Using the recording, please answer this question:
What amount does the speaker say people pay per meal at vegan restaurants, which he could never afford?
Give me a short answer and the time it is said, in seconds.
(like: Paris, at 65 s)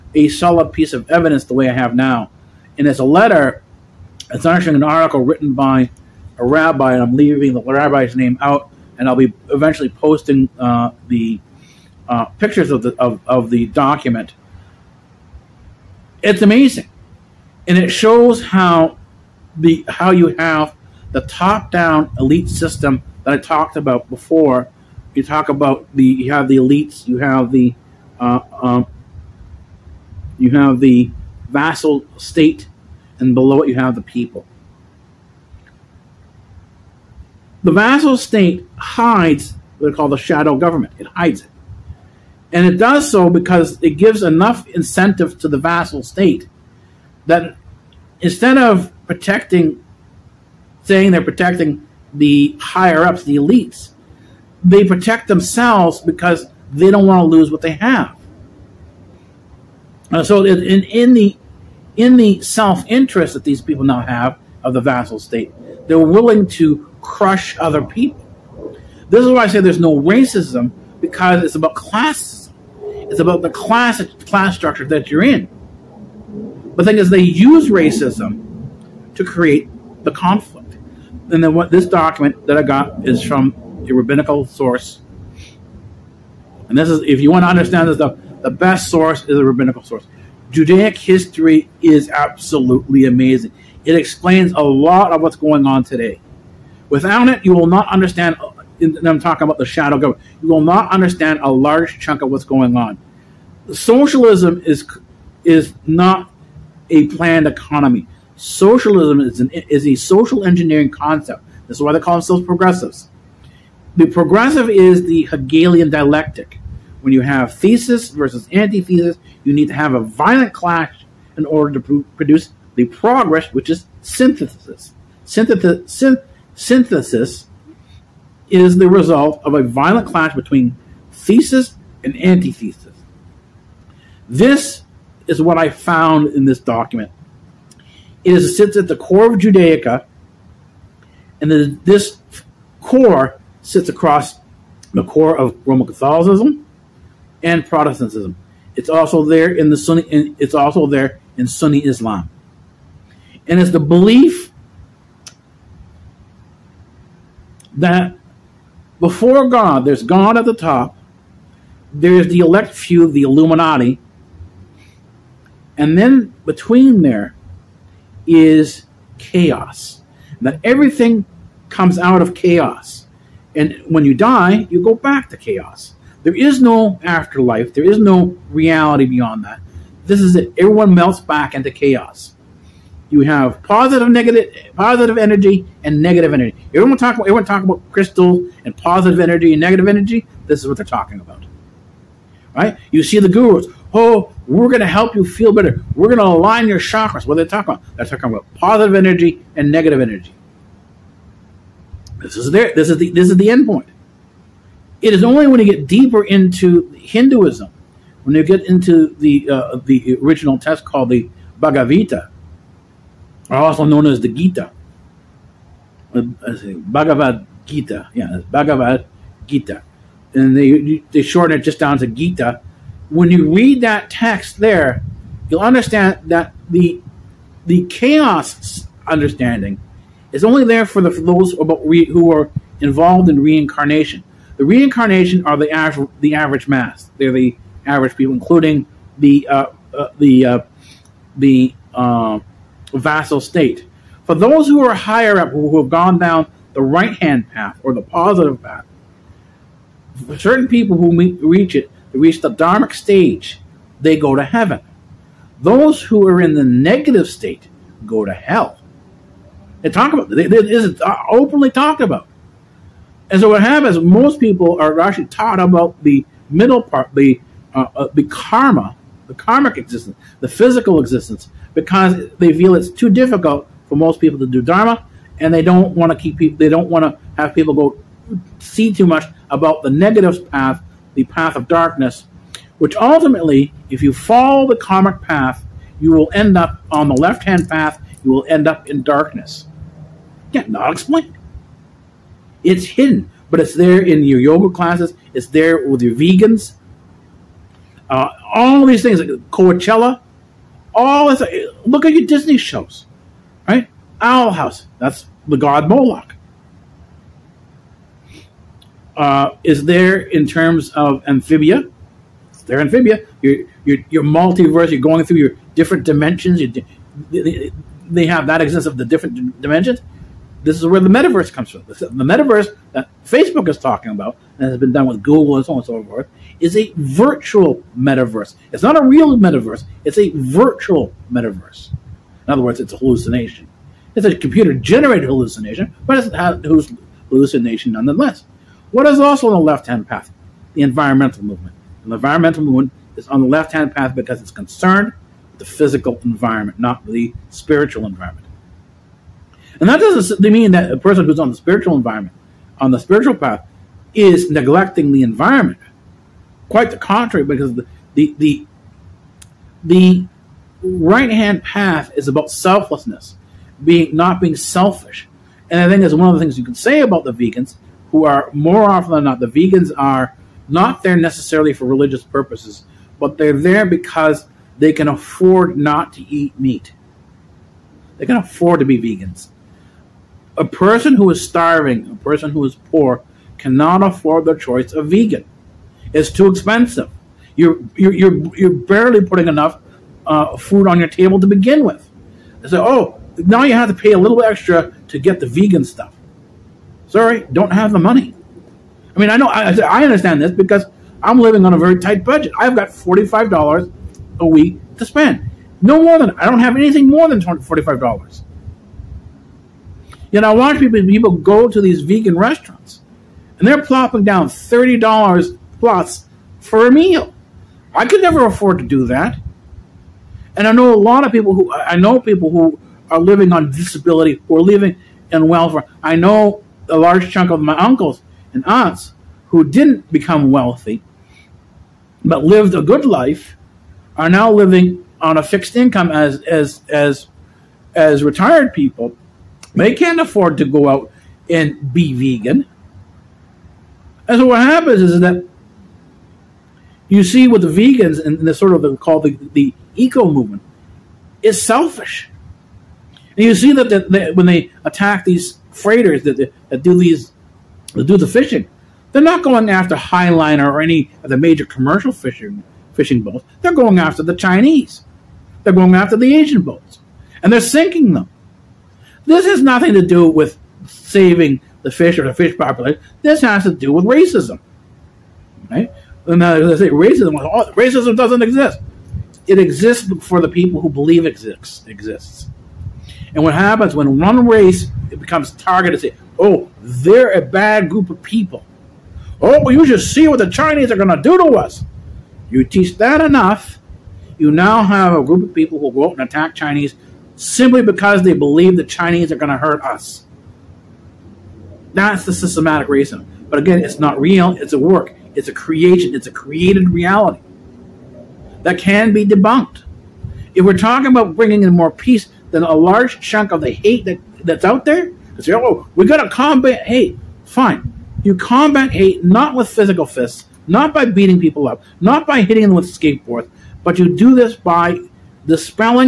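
$30, at 414 s.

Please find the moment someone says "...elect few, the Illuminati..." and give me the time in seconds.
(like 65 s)
162 s.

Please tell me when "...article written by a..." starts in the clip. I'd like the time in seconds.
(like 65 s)
4 s.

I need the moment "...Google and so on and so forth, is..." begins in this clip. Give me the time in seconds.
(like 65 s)
325 s.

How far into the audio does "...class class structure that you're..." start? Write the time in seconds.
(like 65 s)
73 s.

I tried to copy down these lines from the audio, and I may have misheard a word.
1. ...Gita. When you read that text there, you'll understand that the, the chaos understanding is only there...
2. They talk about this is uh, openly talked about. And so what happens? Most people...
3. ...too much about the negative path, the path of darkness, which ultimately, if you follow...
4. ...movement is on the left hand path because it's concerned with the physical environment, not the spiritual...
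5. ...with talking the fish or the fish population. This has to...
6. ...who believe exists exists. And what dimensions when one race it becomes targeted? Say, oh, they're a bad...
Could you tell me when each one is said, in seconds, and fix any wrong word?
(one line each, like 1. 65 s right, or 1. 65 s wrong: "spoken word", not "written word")
1. 222 s right
2. 259 s right
3. 278 s right
4. 342 s right
5. 470 s wrong: "saving", not "talking"
6. 480 s wrong: "happens", not "dimensions".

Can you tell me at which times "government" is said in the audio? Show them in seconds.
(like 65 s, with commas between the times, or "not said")
40 s, 99 s.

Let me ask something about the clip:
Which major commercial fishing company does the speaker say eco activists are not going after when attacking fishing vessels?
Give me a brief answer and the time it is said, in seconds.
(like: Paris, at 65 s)
Highliner, at 459 s.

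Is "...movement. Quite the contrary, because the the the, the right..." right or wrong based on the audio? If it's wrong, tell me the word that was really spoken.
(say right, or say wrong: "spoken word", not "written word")
wrong: "environment", not "movement".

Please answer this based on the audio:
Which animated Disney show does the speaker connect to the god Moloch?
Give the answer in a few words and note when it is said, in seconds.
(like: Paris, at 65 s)
Owl House, at 304 s.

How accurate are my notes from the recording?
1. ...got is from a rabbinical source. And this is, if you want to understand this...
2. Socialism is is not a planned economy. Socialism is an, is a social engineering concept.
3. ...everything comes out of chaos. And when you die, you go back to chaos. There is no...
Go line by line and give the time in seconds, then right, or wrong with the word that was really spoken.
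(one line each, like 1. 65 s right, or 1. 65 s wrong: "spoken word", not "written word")
1. 82 s right
2. 103 s right
3. 170 s right.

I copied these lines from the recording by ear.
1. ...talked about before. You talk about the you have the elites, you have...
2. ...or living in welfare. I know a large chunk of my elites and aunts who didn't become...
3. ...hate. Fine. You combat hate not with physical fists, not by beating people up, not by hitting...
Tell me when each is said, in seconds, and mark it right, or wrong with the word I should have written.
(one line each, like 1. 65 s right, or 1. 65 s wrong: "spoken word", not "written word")
1. 23 s right
2. 424 s wrong: "uncles", not "elites"
3. 516 s right.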